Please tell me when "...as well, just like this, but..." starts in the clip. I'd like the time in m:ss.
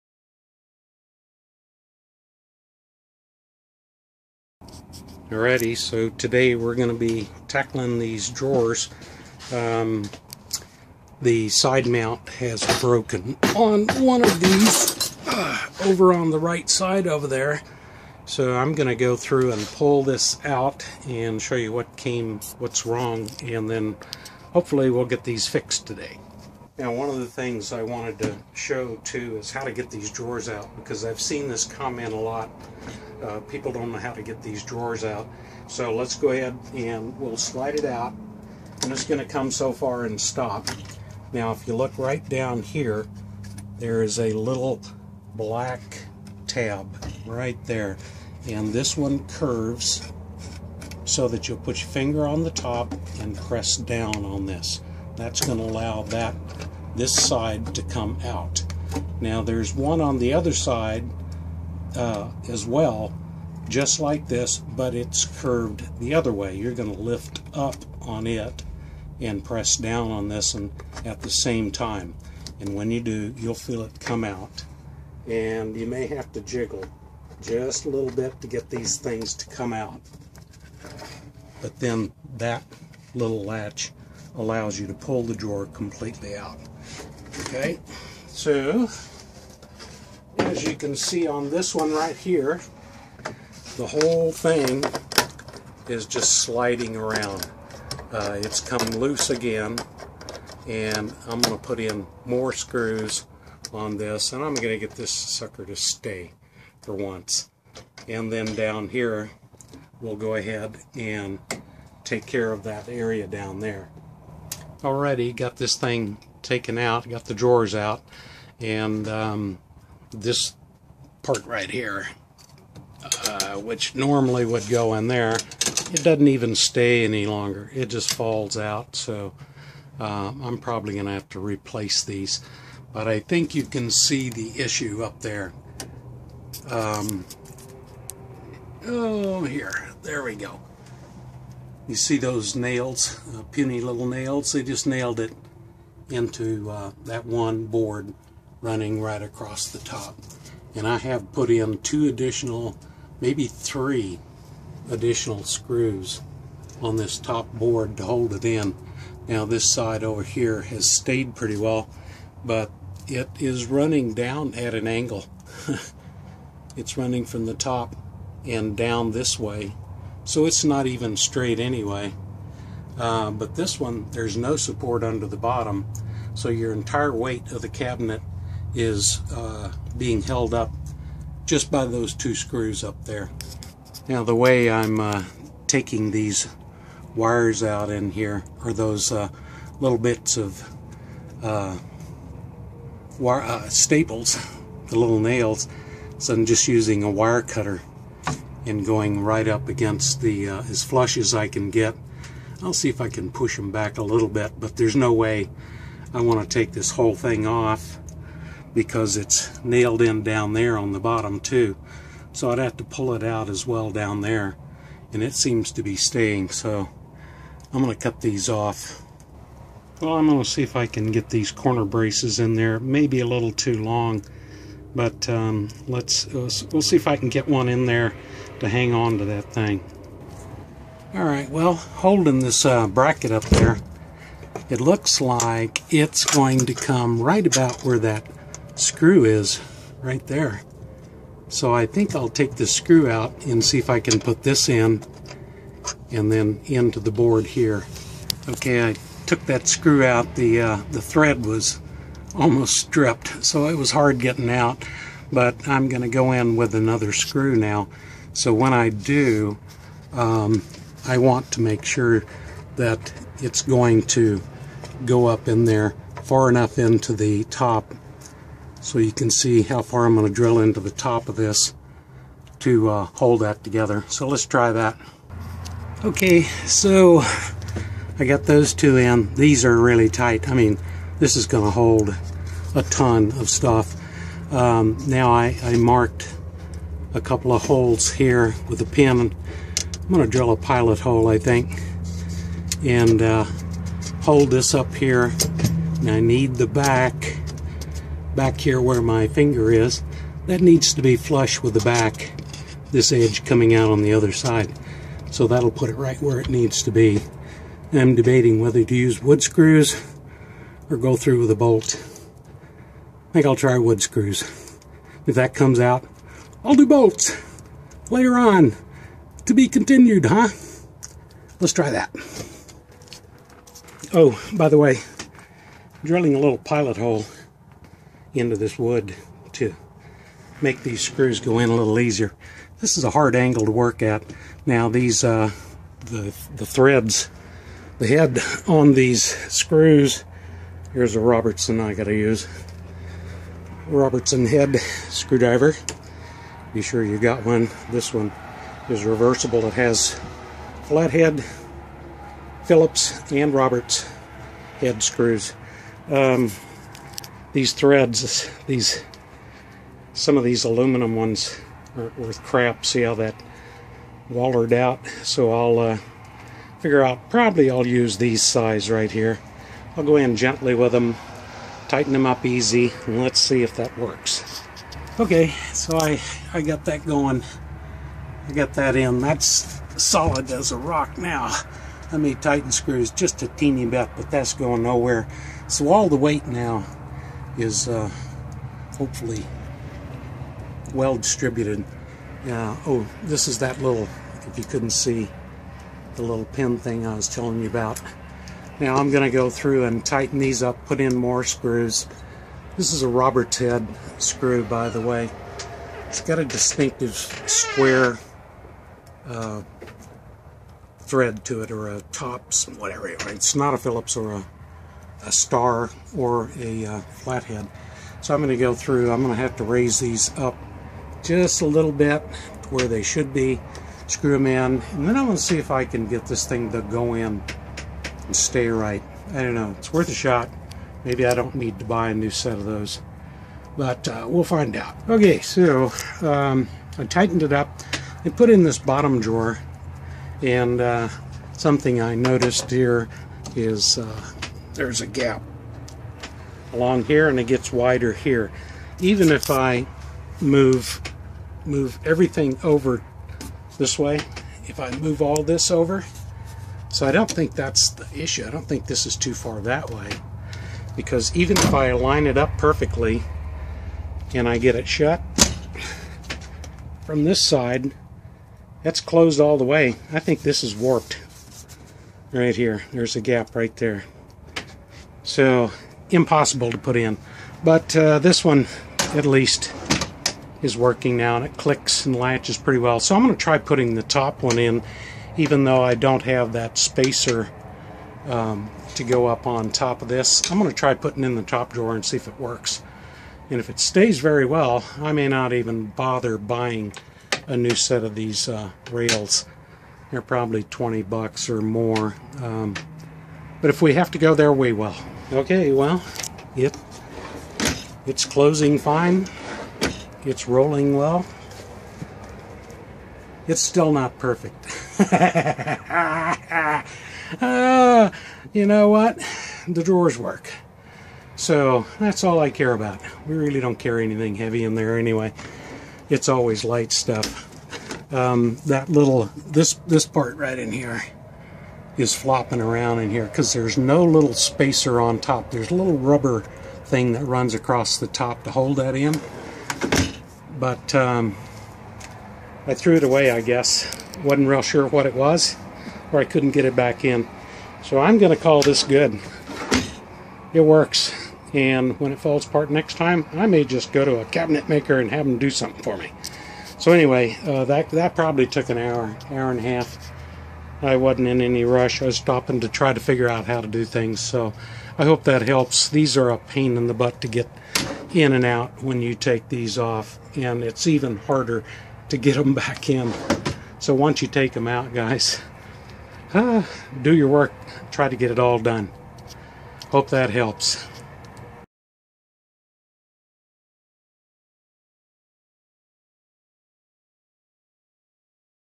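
1:02.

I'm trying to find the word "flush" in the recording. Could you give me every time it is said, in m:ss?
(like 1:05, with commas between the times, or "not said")
3:20, 5:01.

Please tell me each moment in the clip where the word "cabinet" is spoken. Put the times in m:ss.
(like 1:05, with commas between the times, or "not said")
2:57, 9:14.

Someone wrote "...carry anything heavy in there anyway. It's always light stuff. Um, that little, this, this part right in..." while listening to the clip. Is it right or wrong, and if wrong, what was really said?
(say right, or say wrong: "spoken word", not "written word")
right.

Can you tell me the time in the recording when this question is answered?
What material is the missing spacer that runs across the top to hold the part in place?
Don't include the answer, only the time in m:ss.
8:55.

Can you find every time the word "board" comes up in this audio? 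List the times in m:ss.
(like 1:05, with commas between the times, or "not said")
2:27, 2:37, 4:07.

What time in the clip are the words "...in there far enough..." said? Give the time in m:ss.
4:25.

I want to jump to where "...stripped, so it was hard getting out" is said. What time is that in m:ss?
4:12.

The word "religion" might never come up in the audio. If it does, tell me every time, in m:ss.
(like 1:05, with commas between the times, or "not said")
not said.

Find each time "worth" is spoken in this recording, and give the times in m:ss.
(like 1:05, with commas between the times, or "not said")
6:02, 7:09.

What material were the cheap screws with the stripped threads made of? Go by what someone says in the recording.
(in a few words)
Aluminum.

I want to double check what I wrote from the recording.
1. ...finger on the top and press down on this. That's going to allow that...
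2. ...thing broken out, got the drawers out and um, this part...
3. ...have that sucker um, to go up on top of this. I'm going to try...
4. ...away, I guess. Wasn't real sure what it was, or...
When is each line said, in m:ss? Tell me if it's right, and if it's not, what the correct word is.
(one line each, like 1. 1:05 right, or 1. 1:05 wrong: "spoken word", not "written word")
1. 0:51 right
2. 1:55 wrong: "taken", not "broken"
3. 8:06 wrong: "spacer", not "sucker"
4. 9:03 right.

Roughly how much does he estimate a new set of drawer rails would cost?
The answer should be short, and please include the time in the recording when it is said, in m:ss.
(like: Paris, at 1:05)
20 bucks or more, at 8:20.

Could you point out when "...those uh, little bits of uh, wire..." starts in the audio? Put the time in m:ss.
3:08.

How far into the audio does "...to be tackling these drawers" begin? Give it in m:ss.
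0:06.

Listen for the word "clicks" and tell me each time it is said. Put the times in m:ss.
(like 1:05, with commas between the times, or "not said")
8:01.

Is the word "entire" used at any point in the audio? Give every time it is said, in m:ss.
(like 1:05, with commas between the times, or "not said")
2:56.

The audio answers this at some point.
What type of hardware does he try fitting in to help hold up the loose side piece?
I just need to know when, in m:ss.
3:41.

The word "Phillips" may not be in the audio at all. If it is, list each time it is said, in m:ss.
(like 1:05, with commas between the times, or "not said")
5:52, 6:53.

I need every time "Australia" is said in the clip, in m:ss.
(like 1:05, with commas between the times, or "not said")
not said.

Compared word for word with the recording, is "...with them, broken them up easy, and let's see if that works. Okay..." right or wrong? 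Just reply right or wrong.
wrong.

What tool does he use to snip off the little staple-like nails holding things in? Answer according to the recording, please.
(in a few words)
Wire cutter.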